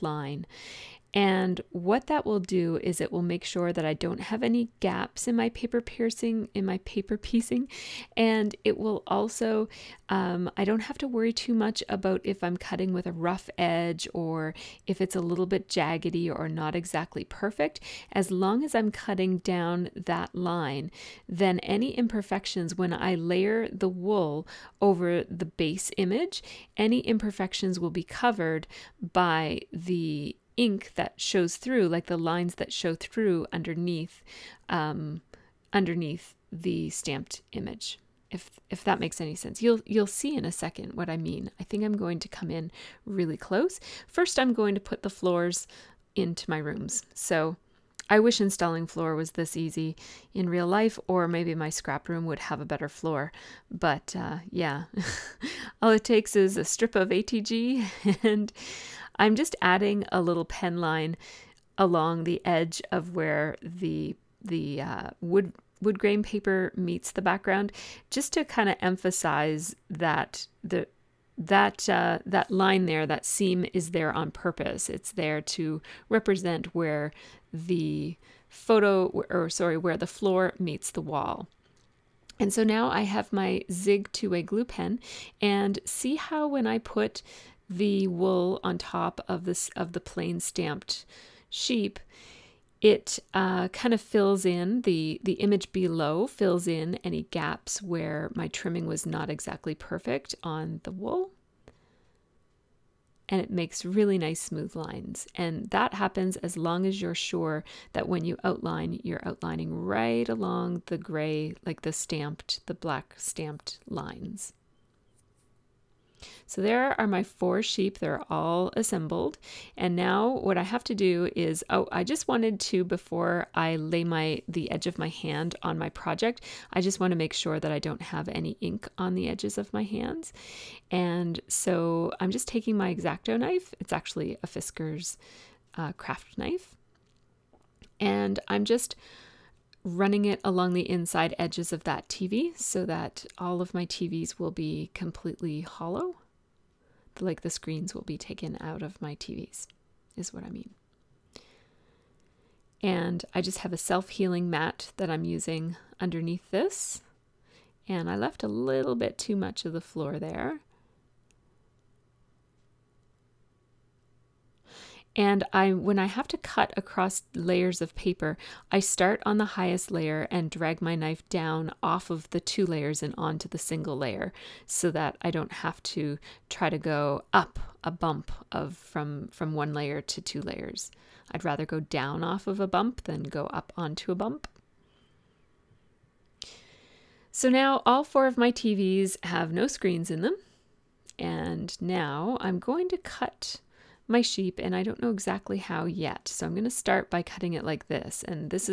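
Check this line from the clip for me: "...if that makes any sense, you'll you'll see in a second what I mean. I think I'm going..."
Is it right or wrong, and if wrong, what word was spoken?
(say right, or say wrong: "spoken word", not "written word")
right.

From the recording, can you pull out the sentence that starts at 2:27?
Like the screens will be taken out of my TVs, is what I mean.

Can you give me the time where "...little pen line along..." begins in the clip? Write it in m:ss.
1:00.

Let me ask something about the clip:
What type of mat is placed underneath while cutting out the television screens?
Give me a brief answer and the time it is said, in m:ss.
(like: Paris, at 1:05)
self-healing mat, at 2:33.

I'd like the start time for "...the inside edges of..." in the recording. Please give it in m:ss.
2:20.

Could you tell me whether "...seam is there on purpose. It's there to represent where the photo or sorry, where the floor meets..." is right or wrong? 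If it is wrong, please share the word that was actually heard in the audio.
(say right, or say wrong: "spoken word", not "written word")
right.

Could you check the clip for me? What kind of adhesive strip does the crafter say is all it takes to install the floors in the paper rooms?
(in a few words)
ATG.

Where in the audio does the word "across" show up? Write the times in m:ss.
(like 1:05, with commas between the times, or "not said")
2:46.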